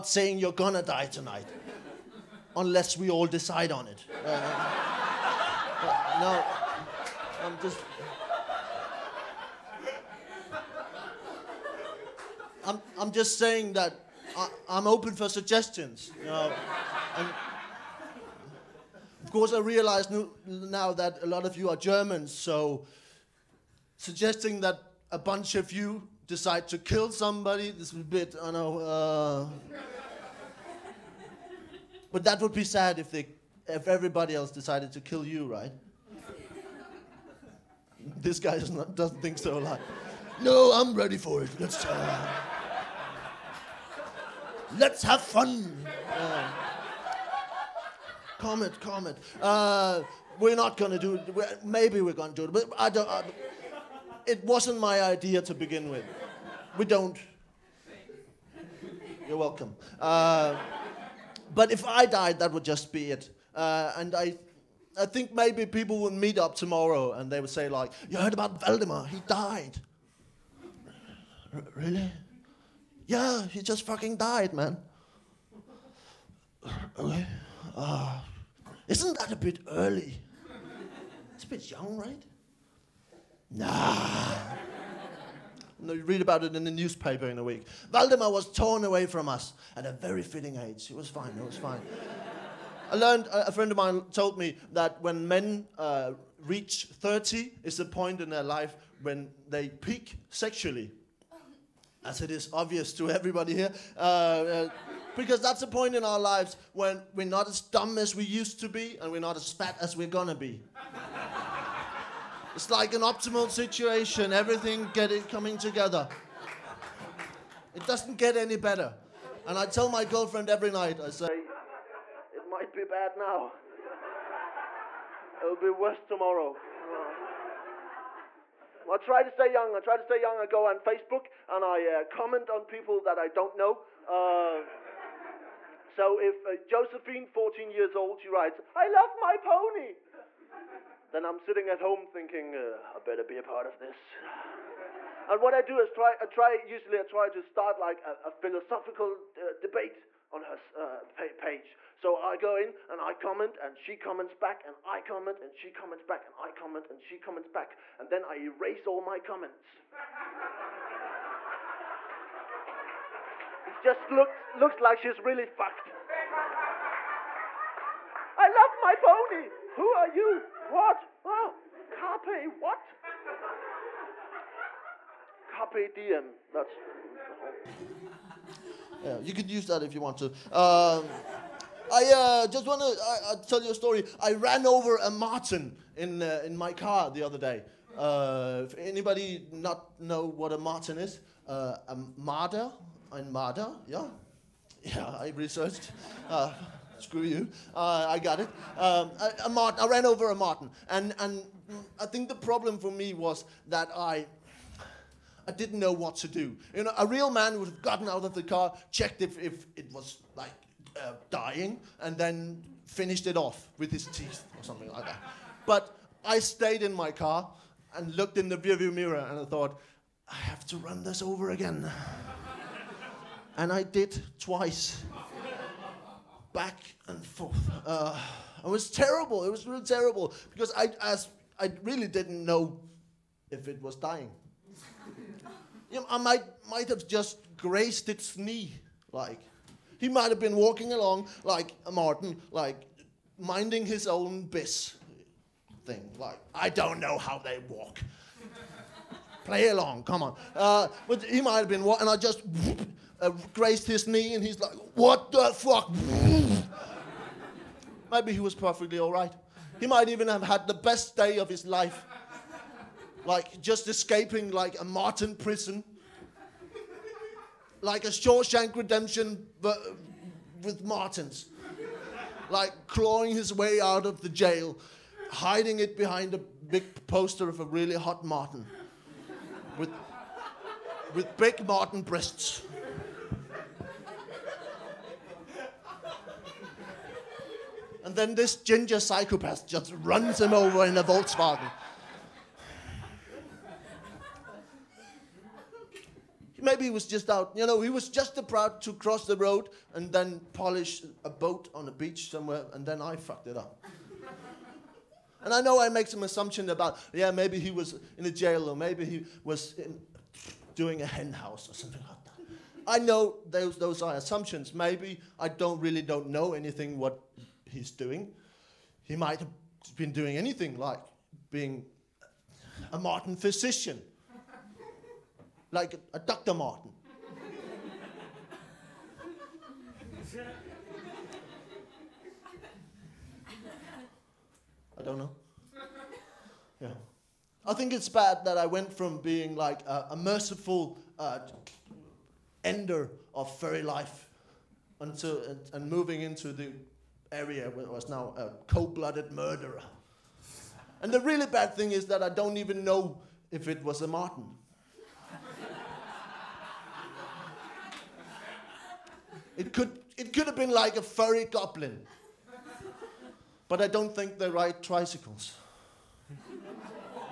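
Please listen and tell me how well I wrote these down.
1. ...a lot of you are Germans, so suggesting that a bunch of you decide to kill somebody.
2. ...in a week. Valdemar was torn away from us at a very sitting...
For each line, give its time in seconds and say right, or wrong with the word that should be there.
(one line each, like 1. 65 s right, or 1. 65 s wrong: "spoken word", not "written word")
1. 21 s right
2. 87 s wrong: "fitting", not "sitting".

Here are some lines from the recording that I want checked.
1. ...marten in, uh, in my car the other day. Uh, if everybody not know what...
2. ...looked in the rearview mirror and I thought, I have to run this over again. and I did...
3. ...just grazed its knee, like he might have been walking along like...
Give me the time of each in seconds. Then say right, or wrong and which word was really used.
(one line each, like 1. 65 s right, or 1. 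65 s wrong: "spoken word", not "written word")
1. 185 s wrong: "anybody", not "everybody"
2. 218 s right
3. 237 s right.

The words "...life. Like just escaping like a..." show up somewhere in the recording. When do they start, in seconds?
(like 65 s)
261 s.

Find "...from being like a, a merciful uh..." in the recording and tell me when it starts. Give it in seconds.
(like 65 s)
338 s.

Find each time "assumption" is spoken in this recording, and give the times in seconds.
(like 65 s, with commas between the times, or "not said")
306 s, 314 s.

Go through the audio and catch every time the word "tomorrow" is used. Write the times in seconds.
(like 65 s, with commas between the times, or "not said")
66 s, 126 s.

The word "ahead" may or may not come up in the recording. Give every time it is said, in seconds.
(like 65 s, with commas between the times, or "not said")
not said.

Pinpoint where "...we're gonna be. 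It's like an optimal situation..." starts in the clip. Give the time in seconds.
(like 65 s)
109 s.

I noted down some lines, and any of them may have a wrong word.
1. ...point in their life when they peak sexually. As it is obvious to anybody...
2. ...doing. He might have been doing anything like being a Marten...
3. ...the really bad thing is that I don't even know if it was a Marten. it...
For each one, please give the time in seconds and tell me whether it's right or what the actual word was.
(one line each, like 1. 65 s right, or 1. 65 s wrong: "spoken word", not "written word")
1. 97 s wrong: "everybody", not "anybody"
2. 317 s right
3. 351 s right.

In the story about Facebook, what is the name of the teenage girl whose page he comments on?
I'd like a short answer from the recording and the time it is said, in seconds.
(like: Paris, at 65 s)
Josephine, at 136 s.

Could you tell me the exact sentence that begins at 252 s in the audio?
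Whoop, uh, grazed his knee and he's like, What the fuck?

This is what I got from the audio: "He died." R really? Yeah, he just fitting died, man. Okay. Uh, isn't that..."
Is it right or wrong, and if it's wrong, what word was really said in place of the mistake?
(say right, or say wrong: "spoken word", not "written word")
wrong: "fucking", not "fitting".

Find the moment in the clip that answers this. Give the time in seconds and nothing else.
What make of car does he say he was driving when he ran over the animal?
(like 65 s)
291 s.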